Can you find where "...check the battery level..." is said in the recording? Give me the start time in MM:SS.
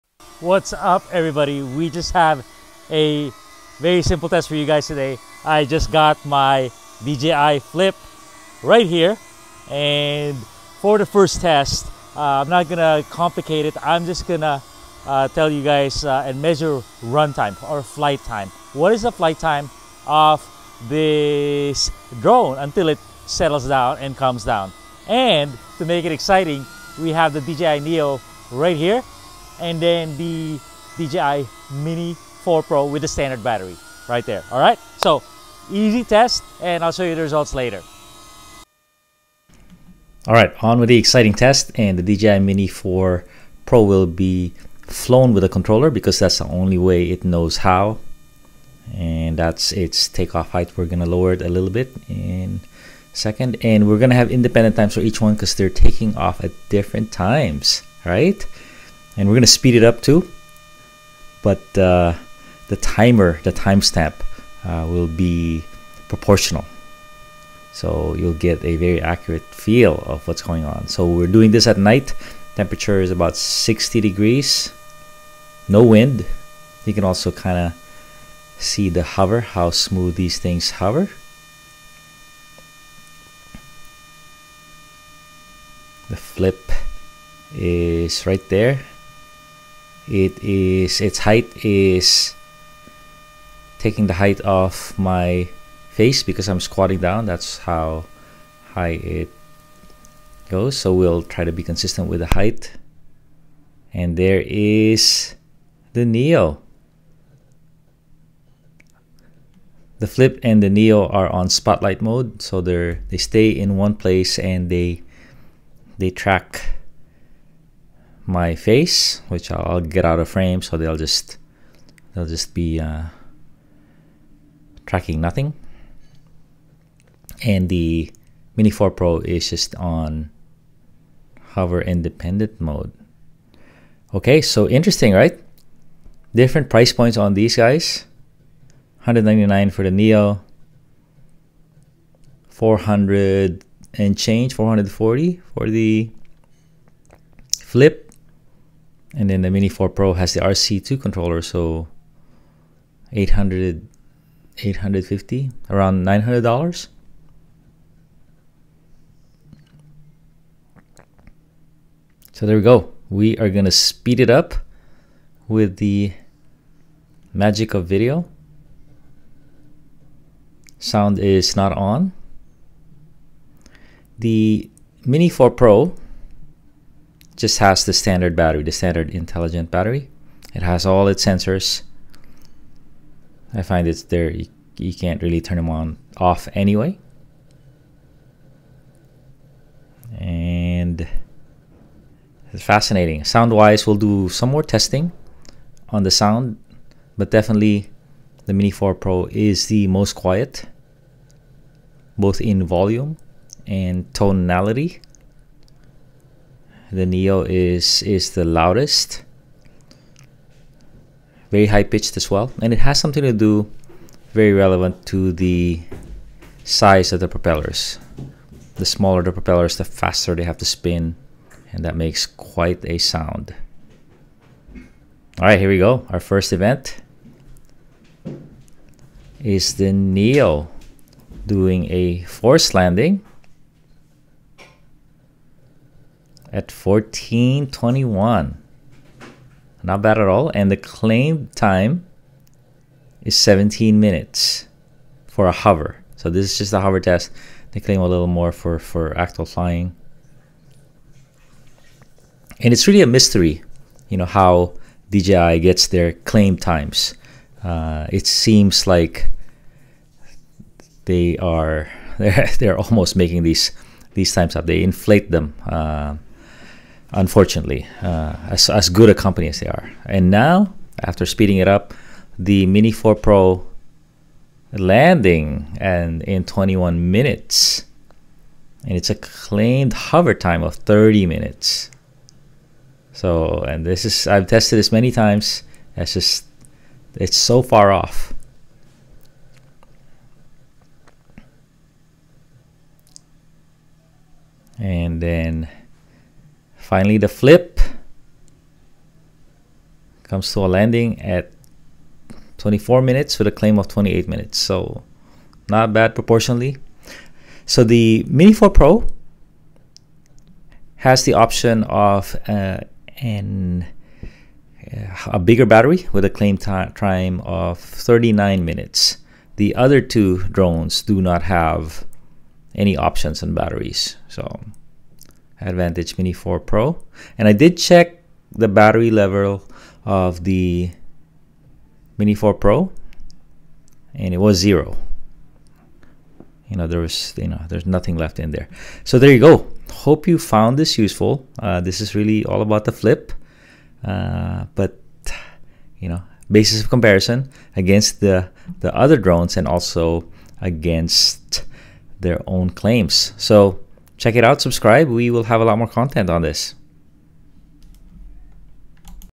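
05:27.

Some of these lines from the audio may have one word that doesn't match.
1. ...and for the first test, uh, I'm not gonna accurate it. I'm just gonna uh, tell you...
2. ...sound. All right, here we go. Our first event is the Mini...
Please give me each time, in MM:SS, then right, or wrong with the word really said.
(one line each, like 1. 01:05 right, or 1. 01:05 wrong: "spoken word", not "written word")
1. 00:09 wrong: "complicate", not "accurate"
2. 03:42 wrong: "Neo", not "Mini".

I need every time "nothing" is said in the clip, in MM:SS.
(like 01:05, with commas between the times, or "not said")
02:05, 05:37.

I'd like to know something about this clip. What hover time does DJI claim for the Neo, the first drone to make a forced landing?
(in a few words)
17 minutes.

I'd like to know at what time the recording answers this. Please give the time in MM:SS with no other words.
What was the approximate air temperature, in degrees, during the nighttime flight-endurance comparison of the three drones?
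01:13.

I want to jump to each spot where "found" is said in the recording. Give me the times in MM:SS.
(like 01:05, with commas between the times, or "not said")
05:40.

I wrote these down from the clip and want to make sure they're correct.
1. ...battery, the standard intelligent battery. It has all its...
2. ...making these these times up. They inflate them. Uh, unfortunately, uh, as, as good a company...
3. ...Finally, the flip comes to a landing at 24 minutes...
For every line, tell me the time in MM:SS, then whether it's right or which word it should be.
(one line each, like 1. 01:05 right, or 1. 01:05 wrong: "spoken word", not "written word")
1. 02:58 right
2. 04:23 right
3. 04:56 right.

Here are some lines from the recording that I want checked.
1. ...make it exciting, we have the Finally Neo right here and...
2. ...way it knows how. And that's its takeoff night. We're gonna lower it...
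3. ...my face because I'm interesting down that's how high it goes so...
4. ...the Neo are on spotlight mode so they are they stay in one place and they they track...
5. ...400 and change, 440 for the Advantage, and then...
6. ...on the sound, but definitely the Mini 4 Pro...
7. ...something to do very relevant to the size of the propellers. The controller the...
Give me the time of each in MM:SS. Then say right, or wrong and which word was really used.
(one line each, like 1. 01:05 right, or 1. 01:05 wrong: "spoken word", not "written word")
1. 00:25 wrong: "DJI", not "Finally"
2. 00:46 wrong: "height", not "night"
3. 01:34 wrong: "squatting", not "interesting"
4. 01:50 right
5. 02:22 wrong: "Flip", not "Advantage"
6. 03:15 right
7. 03:32 wrong: "smaller", not "controller".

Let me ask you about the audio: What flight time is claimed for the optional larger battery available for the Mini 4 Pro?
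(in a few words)
39 minutes.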